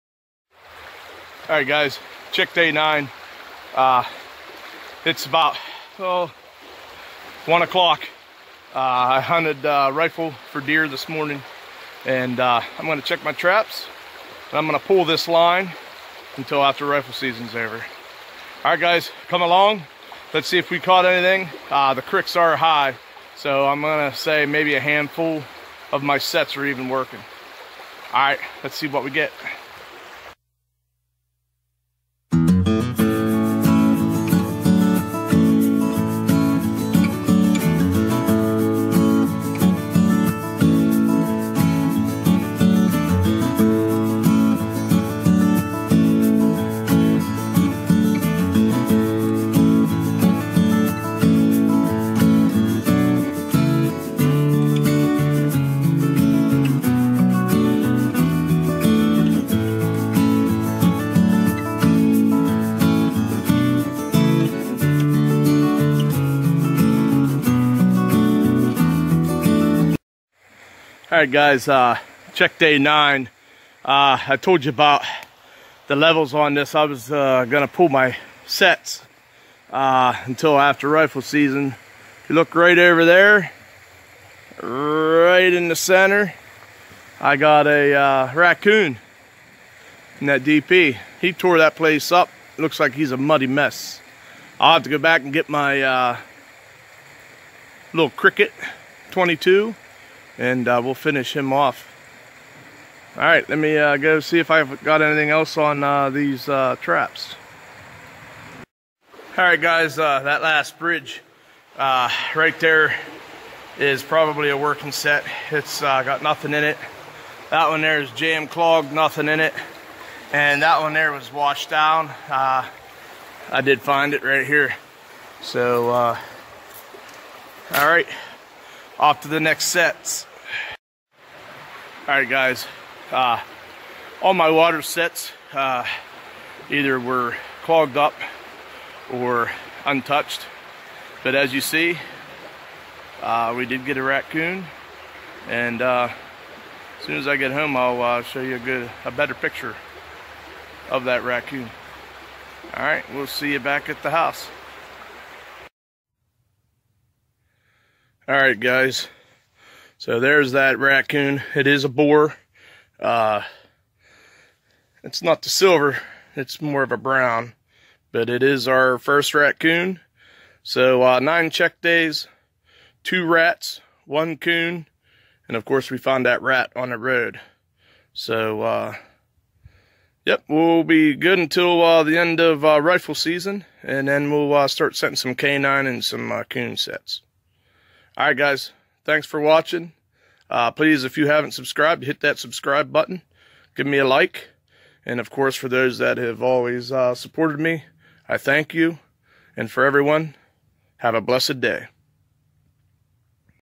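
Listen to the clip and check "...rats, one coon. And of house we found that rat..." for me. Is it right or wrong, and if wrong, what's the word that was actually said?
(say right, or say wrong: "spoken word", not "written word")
wrong: "course", not "house".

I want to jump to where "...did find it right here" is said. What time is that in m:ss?
2:03.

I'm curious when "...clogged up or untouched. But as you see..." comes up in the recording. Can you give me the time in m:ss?
2:17.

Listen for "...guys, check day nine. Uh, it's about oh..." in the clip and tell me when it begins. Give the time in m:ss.
0:01.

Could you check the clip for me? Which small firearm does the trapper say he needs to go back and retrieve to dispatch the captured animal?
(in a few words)
Crickett 22.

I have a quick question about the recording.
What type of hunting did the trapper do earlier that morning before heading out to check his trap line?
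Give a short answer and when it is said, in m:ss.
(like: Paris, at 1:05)
Rifle for deer, at 0:09.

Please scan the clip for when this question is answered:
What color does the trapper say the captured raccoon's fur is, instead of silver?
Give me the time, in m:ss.
2:46.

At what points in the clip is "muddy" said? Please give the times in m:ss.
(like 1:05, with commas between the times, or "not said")
1:33.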